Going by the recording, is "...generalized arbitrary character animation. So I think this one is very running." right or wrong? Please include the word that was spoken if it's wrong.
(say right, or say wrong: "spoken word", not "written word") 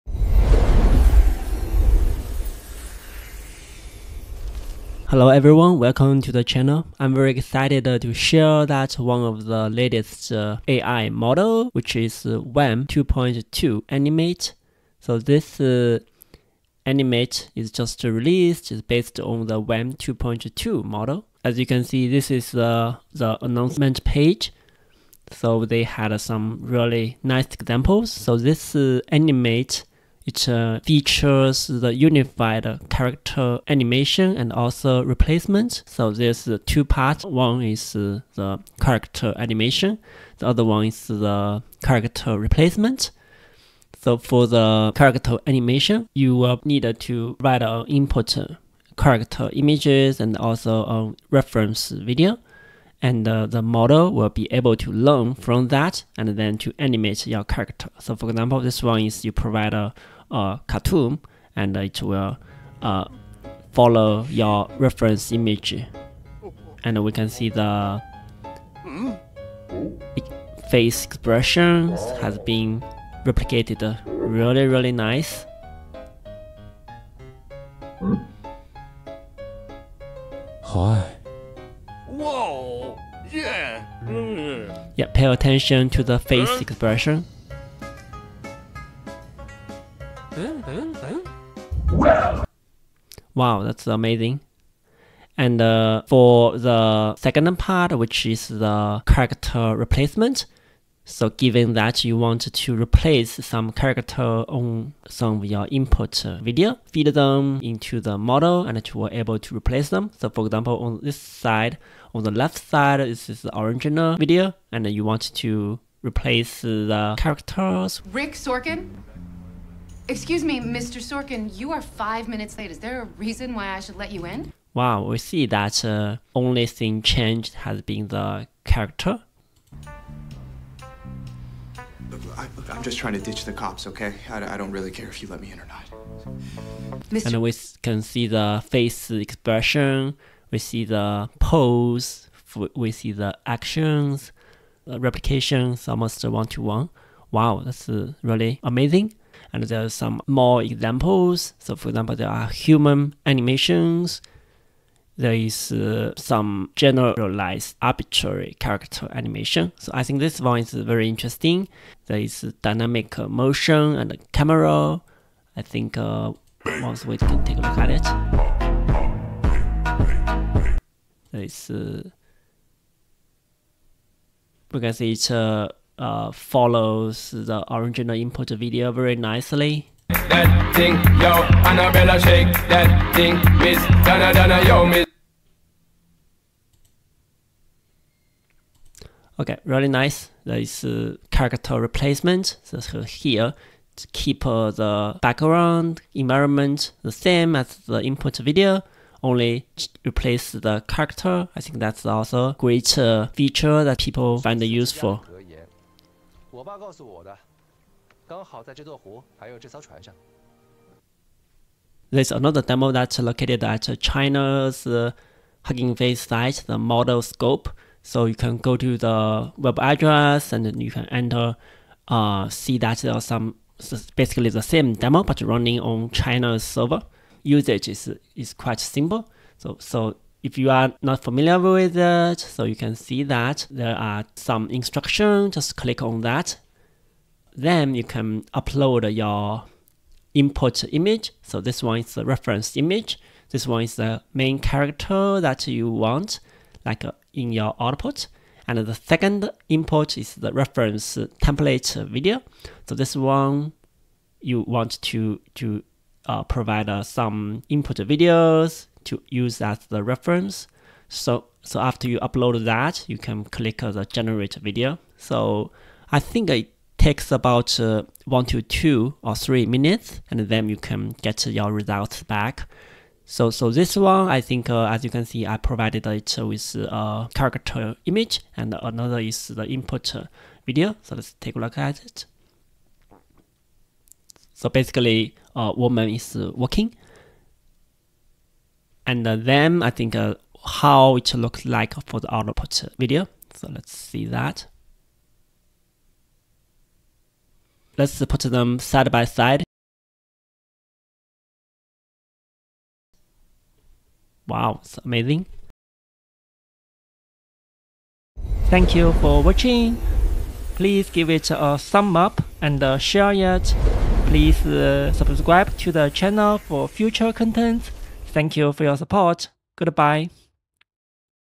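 wrong: "interesting", not "running".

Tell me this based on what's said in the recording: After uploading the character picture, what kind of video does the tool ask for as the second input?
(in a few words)
reference template video.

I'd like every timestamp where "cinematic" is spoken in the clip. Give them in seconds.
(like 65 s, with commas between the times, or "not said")
not said.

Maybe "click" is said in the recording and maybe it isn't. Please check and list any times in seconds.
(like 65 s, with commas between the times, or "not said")
235 s, 263 s.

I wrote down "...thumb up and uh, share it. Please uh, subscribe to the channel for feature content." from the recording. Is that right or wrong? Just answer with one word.
wrong.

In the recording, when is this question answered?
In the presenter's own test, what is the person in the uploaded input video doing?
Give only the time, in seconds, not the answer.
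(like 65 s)
286 s.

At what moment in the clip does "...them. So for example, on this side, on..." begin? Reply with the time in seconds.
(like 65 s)
109 s.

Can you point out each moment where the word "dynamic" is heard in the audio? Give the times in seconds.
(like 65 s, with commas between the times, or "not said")
162 s.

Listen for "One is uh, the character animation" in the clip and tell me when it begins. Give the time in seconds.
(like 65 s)
37 s.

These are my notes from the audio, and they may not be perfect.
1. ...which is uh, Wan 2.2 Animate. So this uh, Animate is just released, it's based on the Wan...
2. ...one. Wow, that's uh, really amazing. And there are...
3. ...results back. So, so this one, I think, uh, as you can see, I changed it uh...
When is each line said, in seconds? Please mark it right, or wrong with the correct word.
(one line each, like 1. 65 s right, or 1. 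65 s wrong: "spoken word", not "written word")
1. 11 s right
2. 146 s right
3. 271 s wrong: "provided", not "changed".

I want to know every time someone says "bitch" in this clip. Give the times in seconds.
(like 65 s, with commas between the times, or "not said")
not said.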